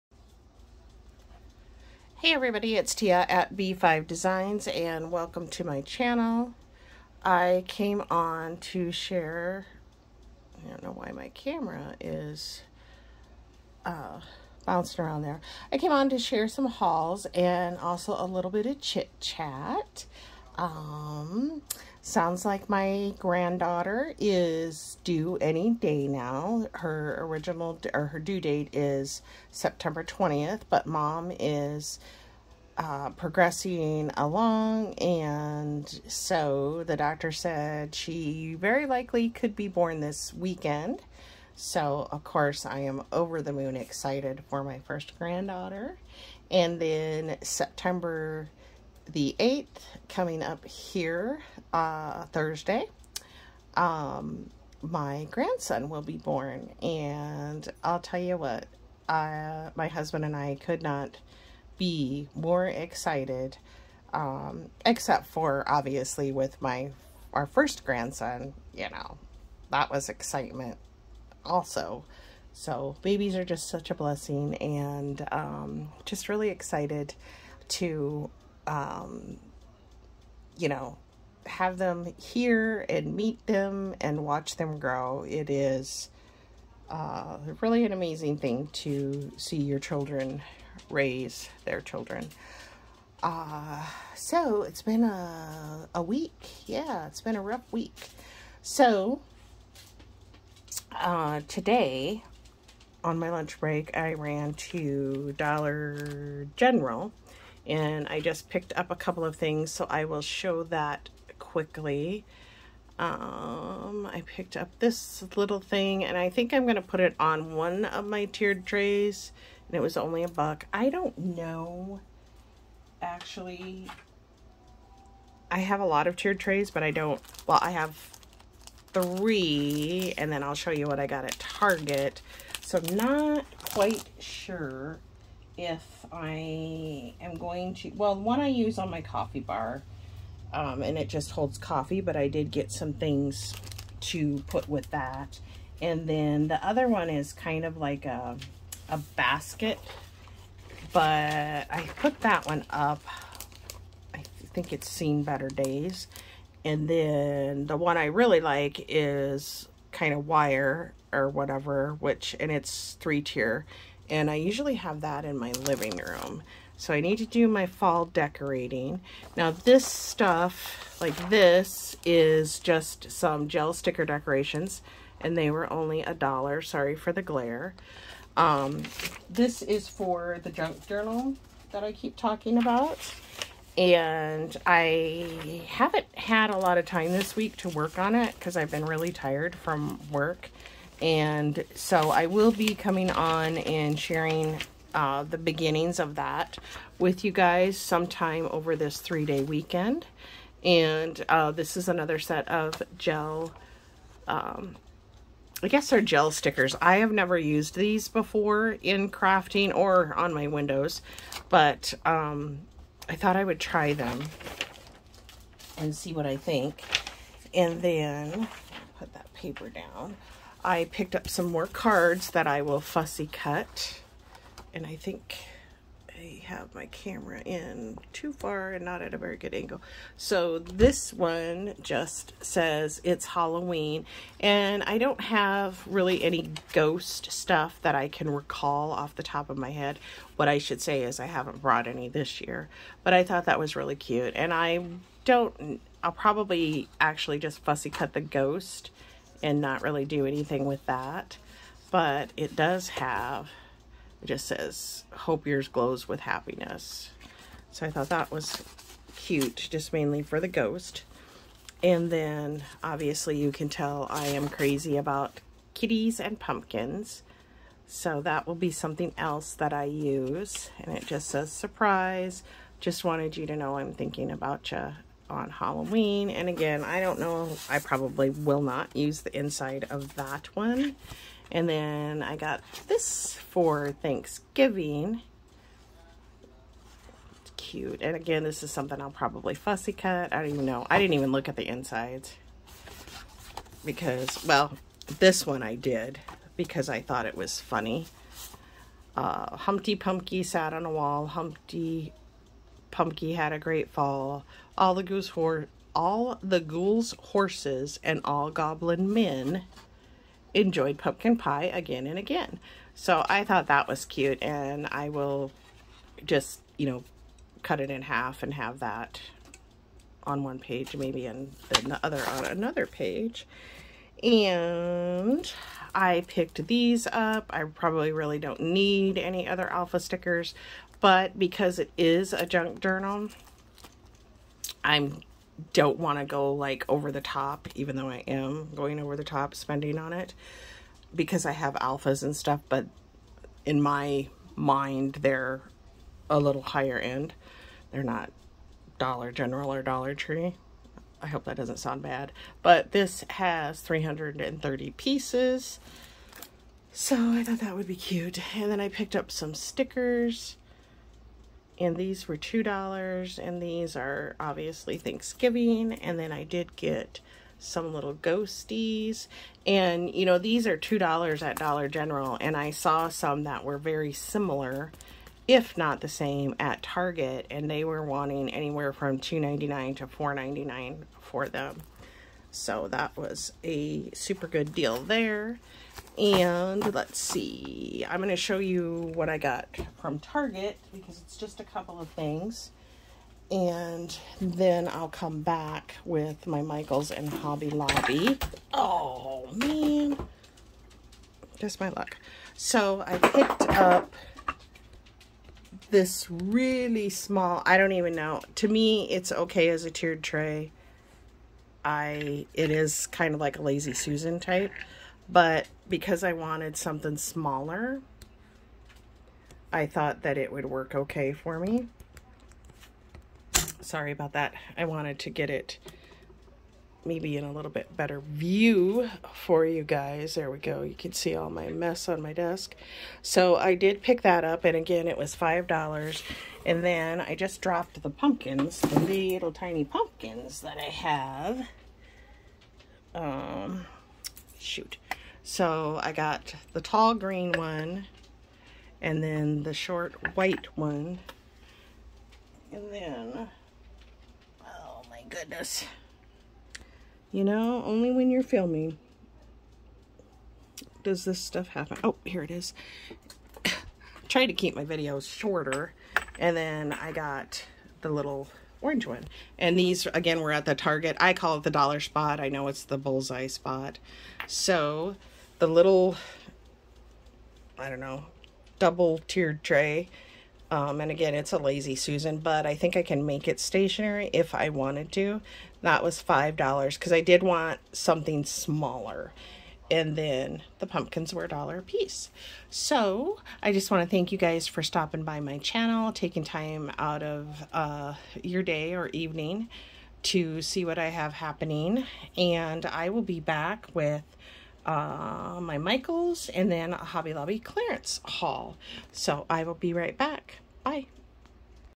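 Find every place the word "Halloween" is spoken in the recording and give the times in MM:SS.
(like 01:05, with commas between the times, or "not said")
03:53, 04:35.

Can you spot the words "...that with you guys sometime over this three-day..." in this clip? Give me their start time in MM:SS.
03:16.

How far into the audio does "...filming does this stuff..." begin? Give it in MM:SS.
07:38.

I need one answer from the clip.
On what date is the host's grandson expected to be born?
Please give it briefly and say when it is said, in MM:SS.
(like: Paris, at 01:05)
September 8th, at 00:47.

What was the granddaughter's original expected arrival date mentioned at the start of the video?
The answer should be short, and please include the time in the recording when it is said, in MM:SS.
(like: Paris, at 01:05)
September 20th, at 00:29.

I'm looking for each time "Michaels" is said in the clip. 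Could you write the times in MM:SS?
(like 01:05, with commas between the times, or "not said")
06:36, 08:25.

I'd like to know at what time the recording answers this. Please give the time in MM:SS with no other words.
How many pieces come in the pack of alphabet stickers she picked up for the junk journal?
05:53.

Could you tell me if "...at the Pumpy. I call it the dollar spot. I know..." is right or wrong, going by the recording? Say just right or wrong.
wrong.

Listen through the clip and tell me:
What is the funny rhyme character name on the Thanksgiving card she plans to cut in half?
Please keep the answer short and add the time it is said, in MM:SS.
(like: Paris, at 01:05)
Humpty Pumpkin, at 05:01.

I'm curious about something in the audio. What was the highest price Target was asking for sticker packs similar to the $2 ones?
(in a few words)
$4.99.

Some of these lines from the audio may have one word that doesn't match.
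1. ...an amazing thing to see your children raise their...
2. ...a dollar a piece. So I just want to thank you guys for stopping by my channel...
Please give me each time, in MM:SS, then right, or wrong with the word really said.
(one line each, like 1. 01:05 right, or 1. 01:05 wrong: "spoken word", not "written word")
1. 01:27 right
2. 08:11 right.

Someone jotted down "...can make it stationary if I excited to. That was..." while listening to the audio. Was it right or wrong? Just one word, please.
wrong.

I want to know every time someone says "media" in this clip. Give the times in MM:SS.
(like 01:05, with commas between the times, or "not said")
not said.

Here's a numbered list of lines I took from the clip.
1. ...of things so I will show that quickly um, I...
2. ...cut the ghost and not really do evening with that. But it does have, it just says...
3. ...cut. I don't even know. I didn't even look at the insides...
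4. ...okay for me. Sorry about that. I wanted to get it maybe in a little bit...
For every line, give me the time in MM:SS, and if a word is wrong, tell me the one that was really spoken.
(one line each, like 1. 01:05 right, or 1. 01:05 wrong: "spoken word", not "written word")
1. 01:49 right
2. 04:07 wrong: "anything", not "evening"
3. 04:49 right
4. 07:00 right.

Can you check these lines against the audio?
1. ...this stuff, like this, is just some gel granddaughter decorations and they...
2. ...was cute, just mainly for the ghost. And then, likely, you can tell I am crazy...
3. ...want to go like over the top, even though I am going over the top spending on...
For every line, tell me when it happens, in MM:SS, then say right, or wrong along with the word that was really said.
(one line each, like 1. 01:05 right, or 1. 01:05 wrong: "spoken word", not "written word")
1. 02:49 wrong: "sticker", not "granddaughter"
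2. 04:18 wrong: "obviously", not "likely"
3. 05:35 right.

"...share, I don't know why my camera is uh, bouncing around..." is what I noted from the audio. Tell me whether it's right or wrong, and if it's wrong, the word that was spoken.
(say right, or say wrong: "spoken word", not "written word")
right.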